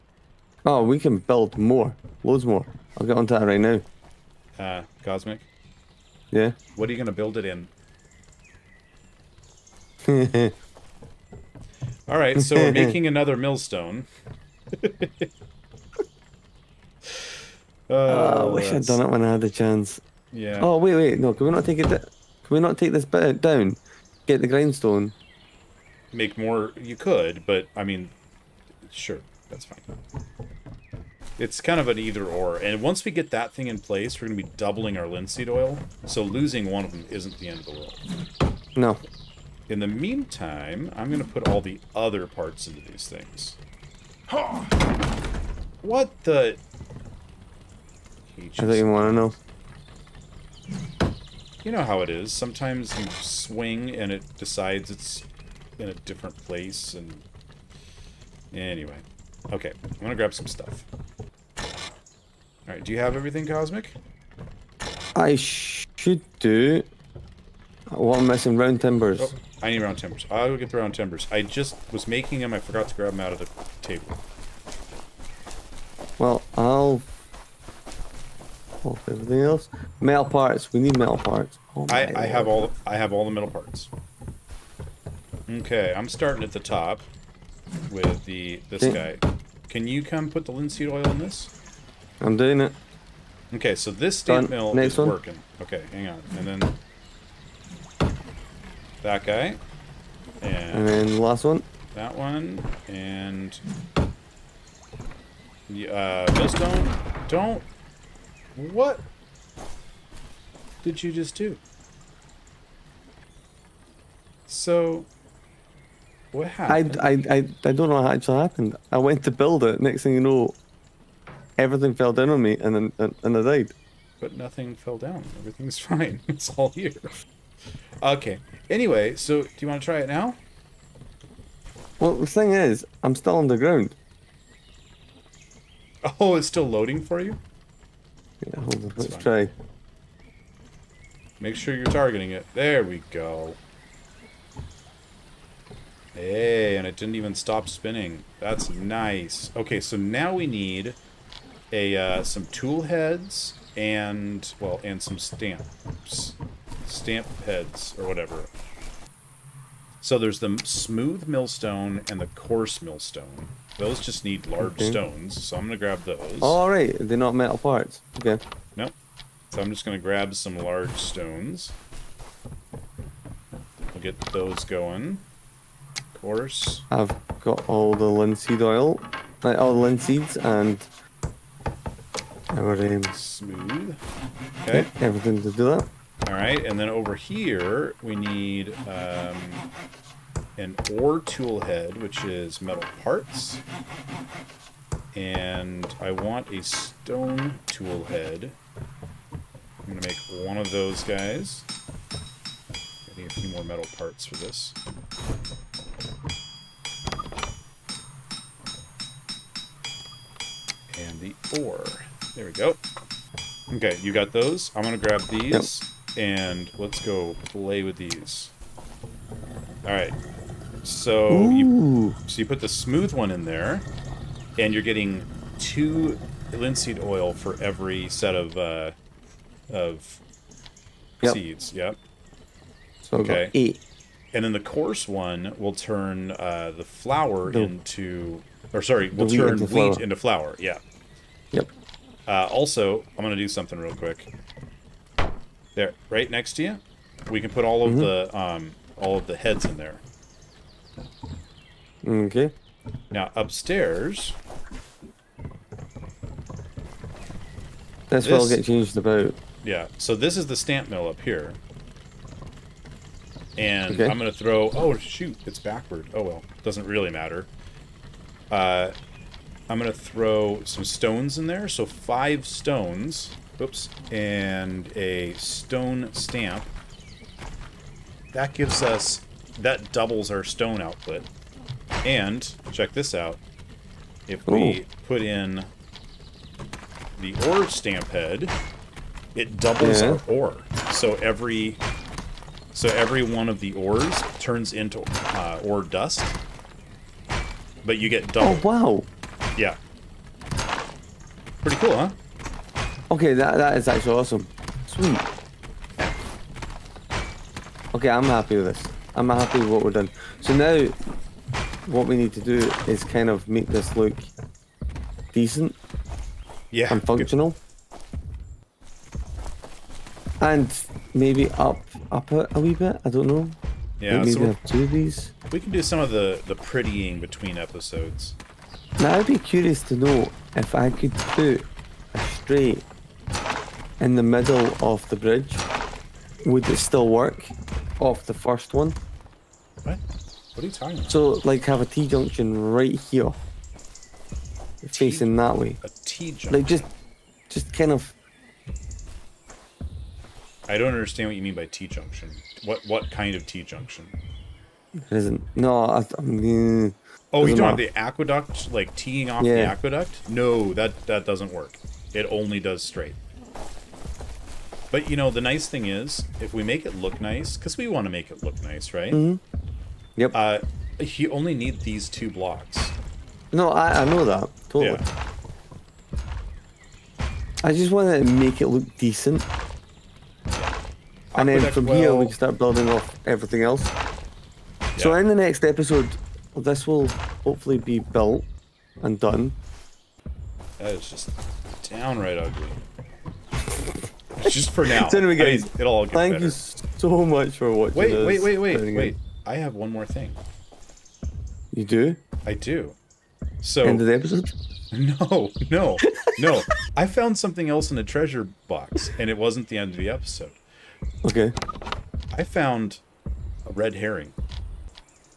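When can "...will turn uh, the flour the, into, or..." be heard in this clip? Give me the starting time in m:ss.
3:55.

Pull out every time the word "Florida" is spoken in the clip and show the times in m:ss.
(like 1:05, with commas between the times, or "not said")
not said.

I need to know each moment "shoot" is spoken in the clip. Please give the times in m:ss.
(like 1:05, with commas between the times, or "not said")
4:24.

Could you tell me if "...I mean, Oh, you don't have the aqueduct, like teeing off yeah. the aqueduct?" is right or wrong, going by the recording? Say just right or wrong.
right.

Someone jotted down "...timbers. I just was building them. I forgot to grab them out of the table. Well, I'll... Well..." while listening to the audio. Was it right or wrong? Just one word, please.
wrong.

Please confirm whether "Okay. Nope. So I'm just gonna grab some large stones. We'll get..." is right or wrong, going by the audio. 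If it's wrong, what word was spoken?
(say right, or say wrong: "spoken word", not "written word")
right.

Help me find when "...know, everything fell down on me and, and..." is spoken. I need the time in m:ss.
2:00.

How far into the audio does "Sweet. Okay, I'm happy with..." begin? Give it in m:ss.
5:04.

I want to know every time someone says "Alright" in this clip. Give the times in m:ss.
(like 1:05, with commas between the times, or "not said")
1:02, 3:39.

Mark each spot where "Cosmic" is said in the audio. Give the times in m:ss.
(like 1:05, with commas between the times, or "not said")
0:05, 1:03.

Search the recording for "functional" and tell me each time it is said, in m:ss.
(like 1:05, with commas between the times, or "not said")
5:17.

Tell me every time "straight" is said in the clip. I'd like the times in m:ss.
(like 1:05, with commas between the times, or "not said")
5:32, 6:02.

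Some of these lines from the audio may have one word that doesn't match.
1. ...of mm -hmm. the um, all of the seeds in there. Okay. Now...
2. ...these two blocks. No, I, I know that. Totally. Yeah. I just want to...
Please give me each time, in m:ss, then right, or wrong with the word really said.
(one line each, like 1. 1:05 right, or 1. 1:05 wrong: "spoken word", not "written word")
1. 4:07 wrong: "heads", not "seeds"
2. 6:11 right.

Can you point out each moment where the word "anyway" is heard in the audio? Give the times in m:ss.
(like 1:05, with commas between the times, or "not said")
0:58, 2:08, 6:35.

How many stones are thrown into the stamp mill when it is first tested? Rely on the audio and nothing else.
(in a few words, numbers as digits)
5.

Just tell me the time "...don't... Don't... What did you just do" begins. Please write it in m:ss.
1:46.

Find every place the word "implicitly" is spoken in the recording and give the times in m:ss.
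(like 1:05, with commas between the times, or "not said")
not said.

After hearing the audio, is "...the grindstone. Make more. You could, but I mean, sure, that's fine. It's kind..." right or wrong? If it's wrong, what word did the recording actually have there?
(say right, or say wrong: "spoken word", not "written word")
right.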